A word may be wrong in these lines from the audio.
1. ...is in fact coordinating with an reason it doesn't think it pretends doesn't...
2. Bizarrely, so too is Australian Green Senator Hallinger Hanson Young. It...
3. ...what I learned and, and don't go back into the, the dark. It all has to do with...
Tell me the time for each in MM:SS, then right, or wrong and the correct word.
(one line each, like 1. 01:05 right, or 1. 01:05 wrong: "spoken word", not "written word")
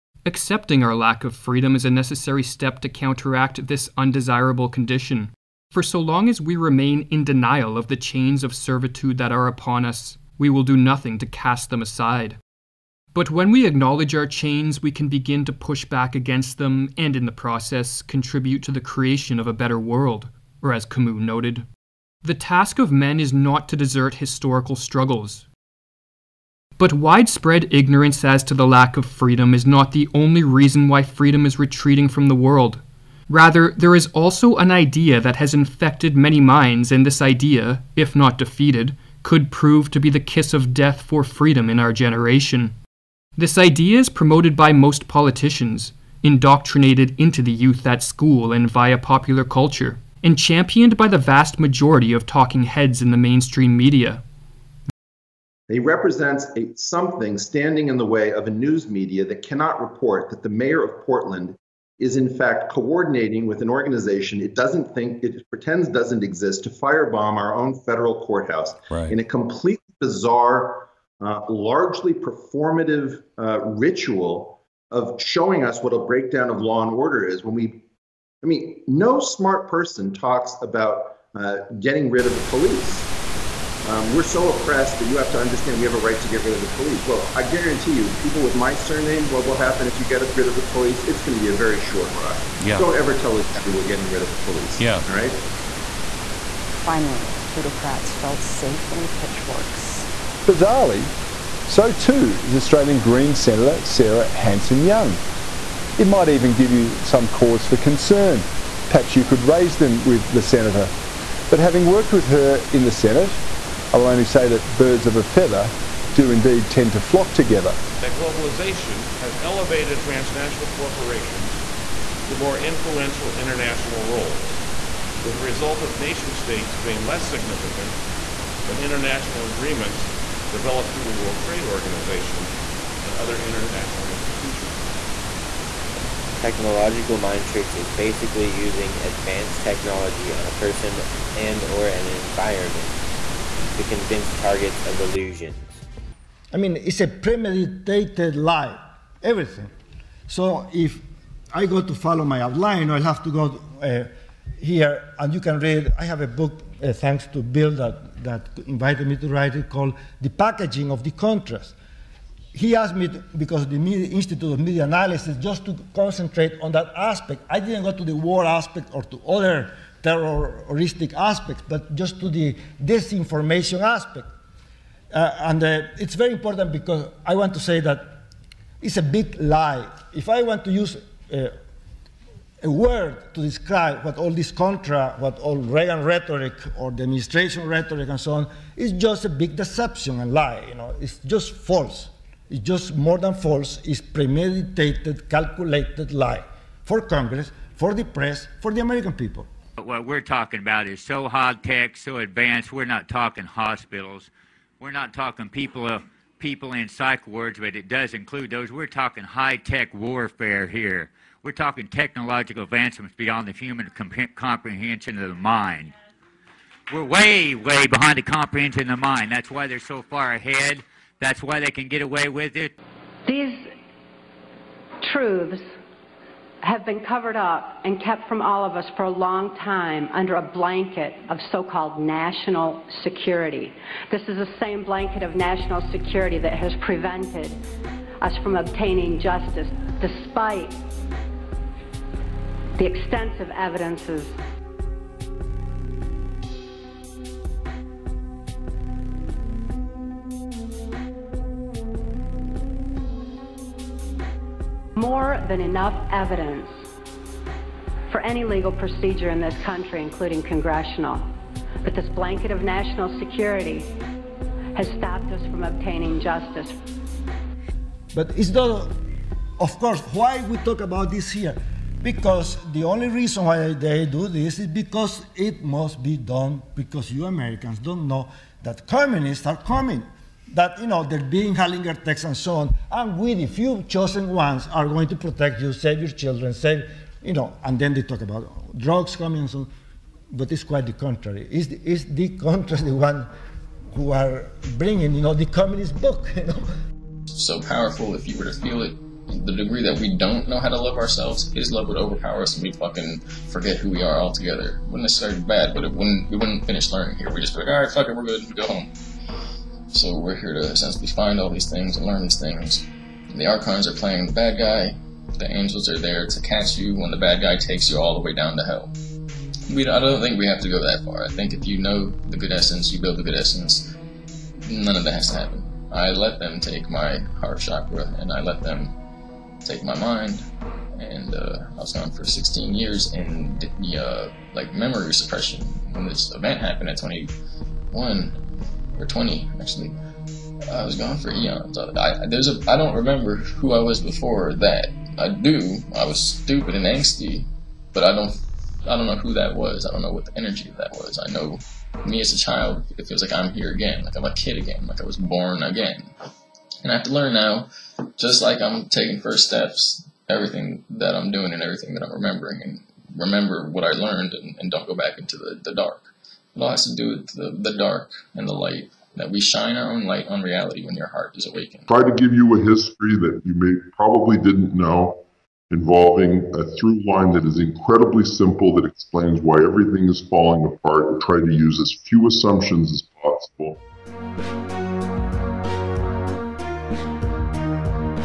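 1. 01:01 wrong: "organization", not "reason"
2. 01:40 wrong: "Sarah", not "Hallinger"
3. 06:03 right.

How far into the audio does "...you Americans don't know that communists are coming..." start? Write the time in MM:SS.
04:37.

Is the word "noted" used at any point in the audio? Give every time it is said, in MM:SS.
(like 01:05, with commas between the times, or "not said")
00:21.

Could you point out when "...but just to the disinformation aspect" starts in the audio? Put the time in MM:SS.
02:51.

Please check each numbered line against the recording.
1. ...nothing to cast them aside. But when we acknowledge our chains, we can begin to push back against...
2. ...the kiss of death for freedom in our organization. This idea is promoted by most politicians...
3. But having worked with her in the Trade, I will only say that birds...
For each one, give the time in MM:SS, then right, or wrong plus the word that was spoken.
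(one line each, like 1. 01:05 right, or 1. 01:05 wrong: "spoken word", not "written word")
1. 00:10 right
2. 00:40 wrong: "generation", not "organization"
3. 01:51 wrong: "Senate", not "Trade".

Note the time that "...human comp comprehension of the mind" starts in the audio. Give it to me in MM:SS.
03:33.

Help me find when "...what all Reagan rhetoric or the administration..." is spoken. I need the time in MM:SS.
03:05.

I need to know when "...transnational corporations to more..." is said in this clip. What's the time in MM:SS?
01:59.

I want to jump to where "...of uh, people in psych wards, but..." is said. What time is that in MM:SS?
03:25.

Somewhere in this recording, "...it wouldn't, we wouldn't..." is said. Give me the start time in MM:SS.
05:05.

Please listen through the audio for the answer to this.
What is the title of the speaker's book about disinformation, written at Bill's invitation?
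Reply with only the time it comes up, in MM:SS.
02:40.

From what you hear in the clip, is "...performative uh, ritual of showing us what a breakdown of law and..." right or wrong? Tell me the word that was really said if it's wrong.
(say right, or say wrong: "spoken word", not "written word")
right.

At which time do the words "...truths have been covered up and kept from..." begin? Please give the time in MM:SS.
03:45.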